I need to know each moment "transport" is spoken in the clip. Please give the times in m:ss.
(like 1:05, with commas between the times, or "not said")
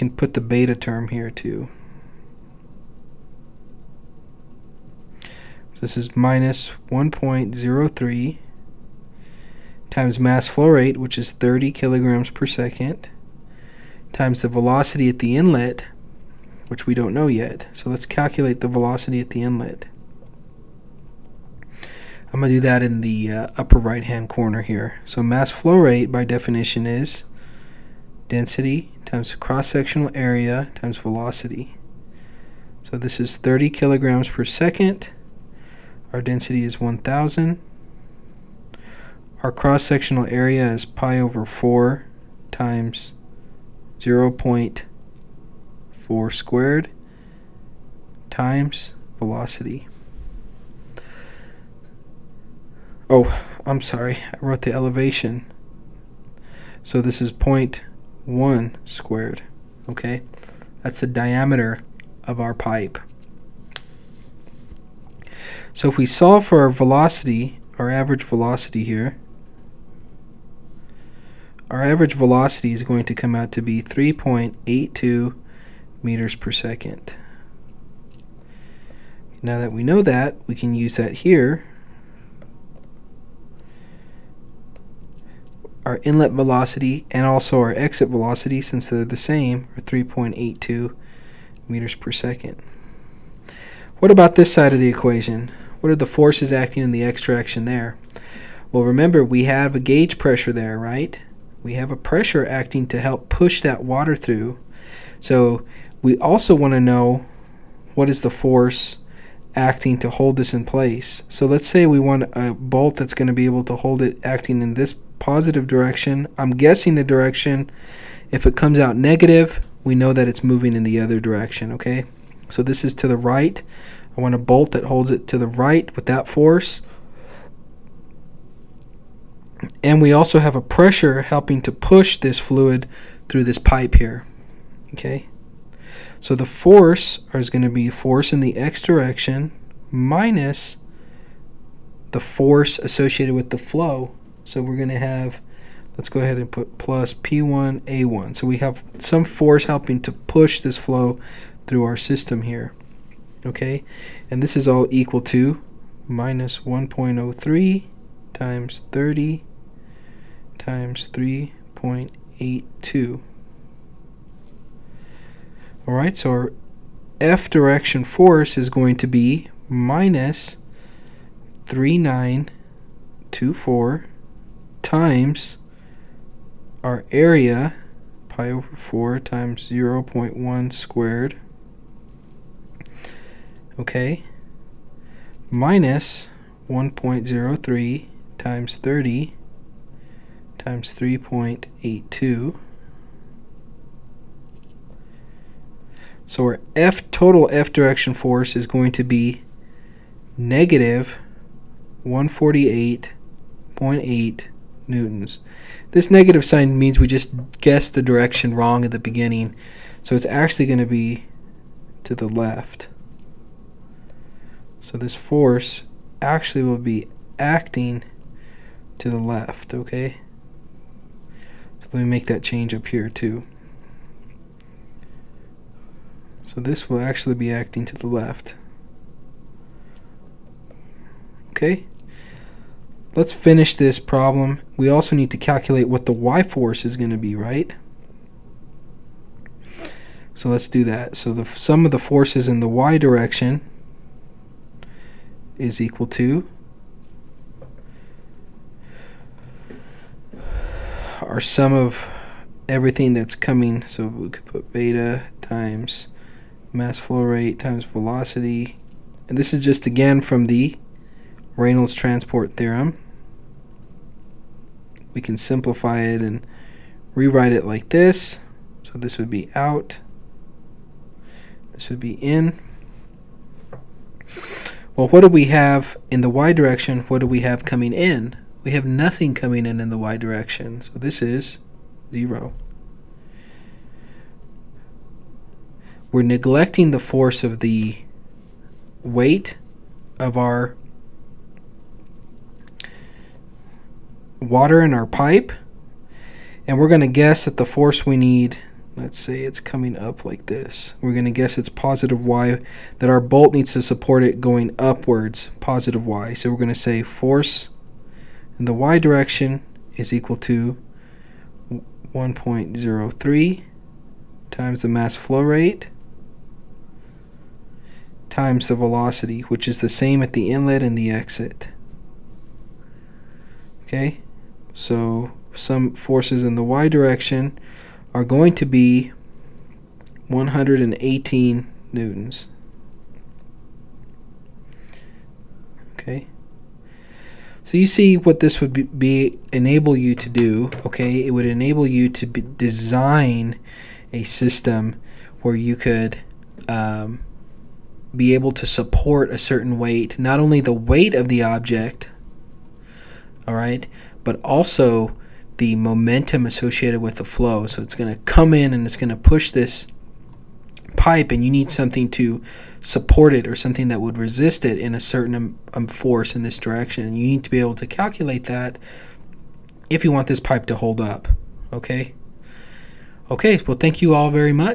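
4:21.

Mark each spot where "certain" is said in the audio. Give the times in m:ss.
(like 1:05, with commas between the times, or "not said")
5:49, 6:04.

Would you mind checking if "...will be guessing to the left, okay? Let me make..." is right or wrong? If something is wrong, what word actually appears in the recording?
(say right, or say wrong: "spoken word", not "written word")
wrong: "acting", not "guessing".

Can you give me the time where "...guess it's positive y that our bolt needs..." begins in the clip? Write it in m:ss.
5:01.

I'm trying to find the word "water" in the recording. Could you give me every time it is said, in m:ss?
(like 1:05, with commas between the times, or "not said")
1:43, 4:54.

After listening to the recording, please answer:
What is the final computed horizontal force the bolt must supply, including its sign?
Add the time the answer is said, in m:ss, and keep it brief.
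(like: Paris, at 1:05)
-148.8 newtons, at 3:20.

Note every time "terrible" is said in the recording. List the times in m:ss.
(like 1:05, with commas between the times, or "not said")
not said.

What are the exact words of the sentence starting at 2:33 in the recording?
Okay, and this is all equal to minus 1.03 times 30 times 3.82.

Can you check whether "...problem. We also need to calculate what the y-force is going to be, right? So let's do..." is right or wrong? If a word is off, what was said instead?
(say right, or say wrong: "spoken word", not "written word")
right.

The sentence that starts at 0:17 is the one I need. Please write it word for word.
So let's calculate the velocity at the inlet.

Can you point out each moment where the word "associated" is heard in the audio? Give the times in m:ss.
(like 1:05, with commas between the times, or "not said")
2:22, 5:56.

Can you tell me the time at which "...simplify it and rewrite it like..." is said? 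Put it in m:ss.
4:25.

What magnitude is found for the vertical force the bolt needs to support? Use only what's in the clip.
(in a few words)
118 newtons.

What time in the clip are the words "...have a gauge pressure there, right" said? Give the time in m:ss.
1:39.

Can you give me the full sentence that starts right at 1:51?
So let's say we want a bolt that's going to be able to hold it acting in this positive direction.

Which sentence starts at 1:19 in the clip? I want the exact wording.
Now that we know that, we can use that here.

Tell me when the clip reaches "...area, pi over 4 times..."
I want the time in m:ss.
2:57.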